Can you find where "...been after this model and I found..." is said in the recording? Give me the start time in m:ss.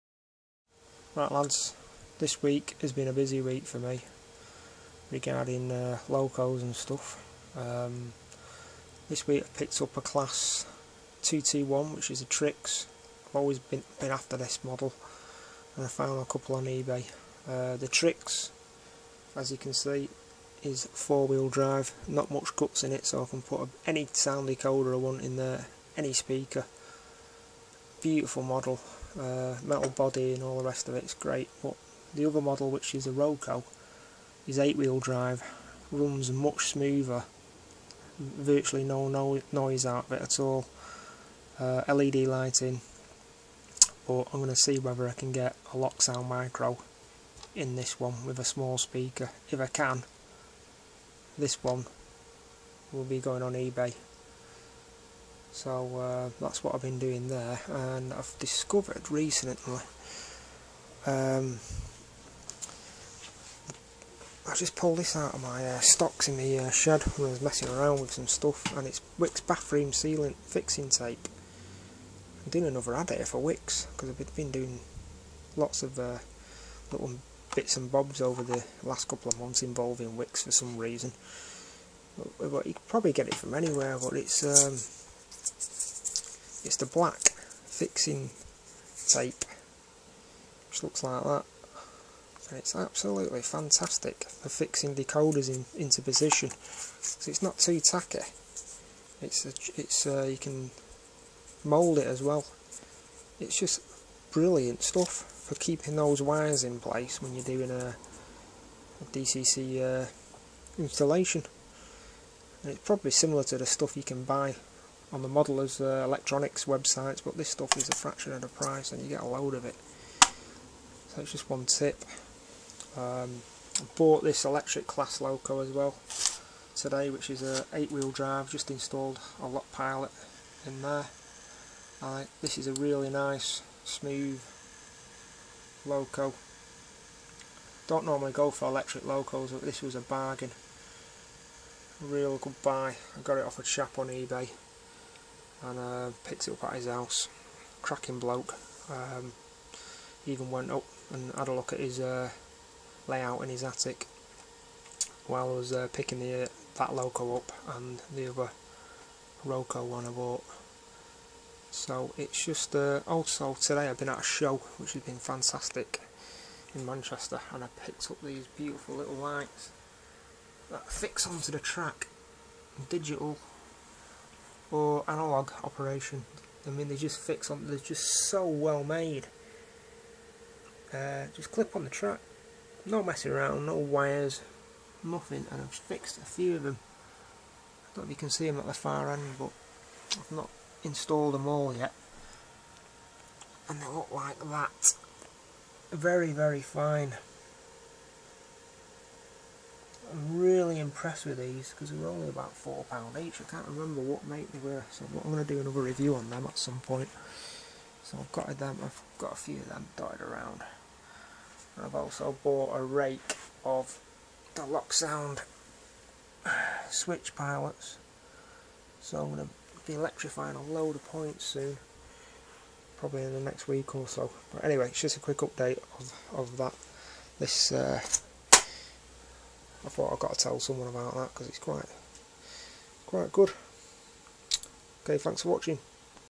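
0:13.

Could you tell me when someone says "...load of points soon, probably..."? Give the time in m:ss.
3:40.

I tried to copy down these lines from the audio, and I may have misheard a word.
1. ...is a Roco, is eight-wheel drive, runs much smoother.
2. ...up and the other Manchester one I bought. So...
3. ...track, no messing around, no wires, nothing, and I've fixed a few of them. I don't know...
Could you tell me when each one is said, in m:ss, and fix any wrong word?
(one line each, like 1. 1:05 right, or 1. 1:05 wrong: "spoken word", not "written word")
1. 0:32 right
2. 2:37 wrong: "Roco", not "Manchester"
3. 3:01 right.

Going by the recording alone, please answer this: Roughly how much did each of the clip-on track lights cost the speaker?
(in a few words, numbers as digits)
£4.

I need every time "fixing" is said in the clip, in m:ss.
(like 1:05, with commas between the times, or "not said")
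1:10, 1:27, 1:34.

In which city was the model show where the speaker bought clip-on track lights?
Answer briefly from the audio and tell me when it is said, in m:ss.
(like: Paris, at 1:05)
Manchester, at 2:46.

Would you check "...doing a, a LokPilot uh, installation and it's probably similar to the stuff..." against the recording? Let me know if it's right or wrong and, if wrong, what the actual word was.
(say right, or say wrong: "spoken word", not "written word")
wrong: "DCC", not "LokPilot".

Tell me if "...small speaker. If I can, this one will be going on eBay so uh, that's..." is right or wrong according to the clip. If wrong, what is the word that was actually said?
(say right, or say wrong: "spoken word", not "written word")
right.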